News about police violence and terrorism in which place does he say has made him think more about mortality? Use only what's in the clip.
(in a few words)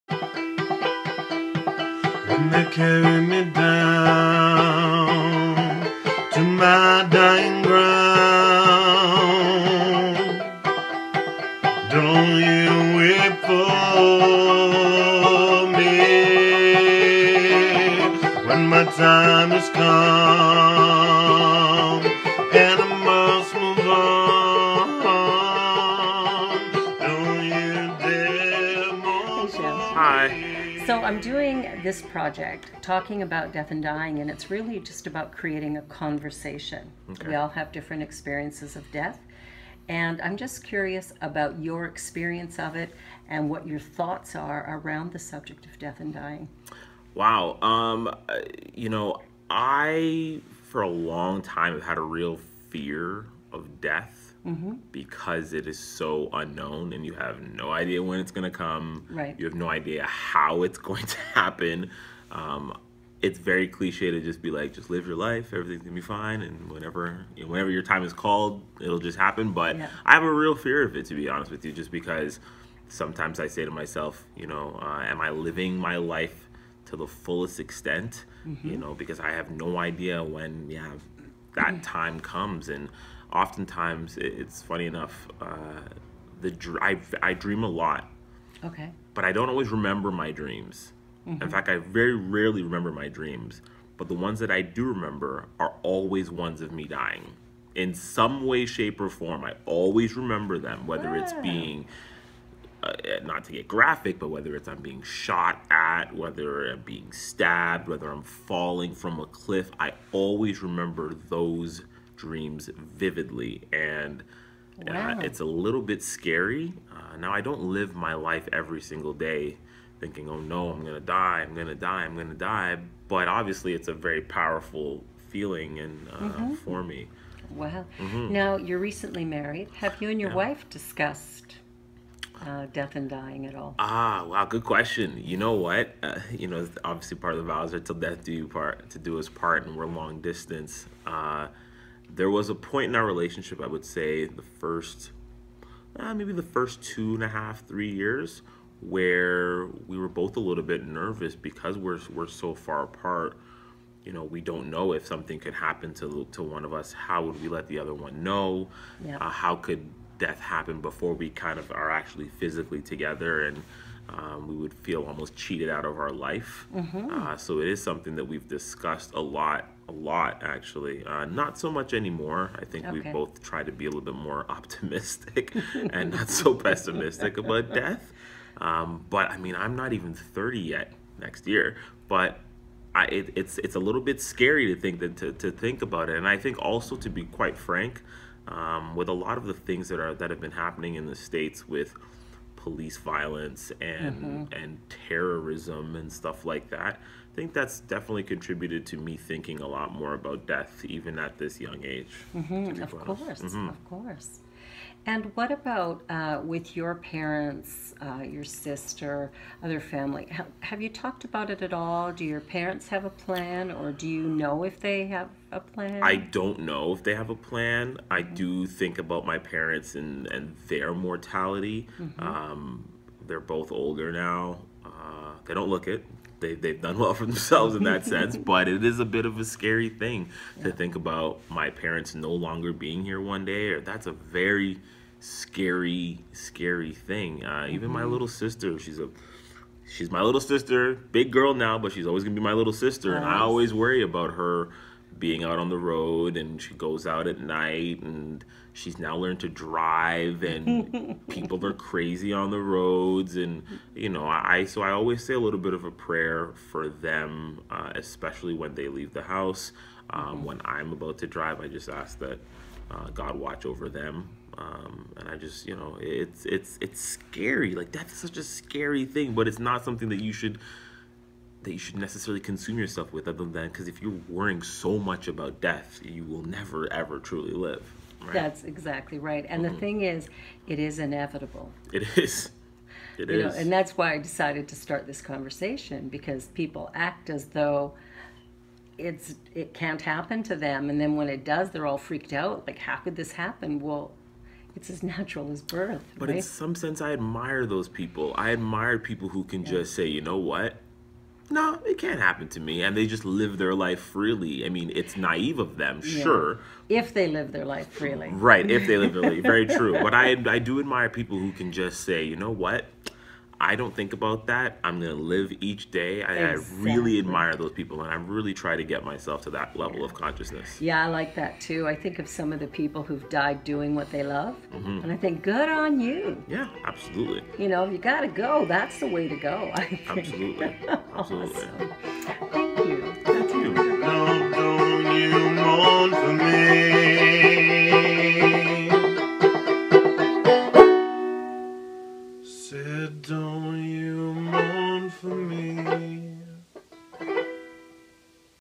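the States.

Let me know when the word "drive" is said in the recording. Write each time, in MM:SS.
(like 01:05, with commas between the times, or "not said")
04:09, 04:21.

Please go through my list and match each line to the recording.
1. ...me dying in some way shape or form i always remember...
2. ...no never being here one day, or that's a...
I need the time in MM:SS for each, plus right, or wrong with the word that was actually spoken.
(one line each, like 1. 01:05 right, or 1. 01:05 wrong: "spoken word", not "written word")
1. 01:36 right
2. 03:52 wrong: "longer", not "never".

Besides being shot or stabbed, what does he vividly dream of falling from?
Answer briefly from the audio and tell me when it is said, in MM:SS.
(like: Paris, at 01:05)
a cliff, at 01:49.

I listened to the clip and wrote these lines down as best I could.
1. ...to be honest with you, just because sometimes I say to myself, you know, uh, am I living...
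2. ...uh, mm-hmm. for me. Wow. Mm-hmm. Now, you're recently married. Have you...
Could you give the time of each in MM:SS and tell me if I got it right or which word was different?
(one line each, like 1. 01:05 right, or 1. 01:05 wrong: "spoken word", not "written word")
1. 01:11 right
2. 02:06 right.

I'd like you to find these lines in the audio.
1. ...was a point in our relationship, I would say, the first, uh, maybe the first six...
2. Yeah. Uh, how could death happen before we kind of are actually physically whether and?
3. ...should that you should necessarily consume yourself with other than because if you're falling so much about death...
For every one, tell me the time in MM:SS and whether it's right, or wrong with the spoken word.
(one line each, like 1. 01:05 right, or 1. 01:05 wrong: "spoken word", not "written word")
1. 02:22 wrong: "two", not "six"
2. 02:39 wrong: "together", not "whether"
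3. 04:30 wrong: "worrying", not "falling".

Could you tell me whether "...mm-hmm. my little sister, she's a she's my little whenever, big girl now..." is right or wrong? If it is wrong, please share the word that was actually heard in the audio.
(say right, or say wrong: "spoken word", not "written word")
wrong: "sister", not "whenever".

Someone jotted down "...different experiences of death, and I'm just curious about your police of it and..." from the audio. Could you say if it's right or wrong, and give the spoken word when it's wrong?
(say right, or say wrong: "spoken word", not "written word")
wrong: "experience", not "police".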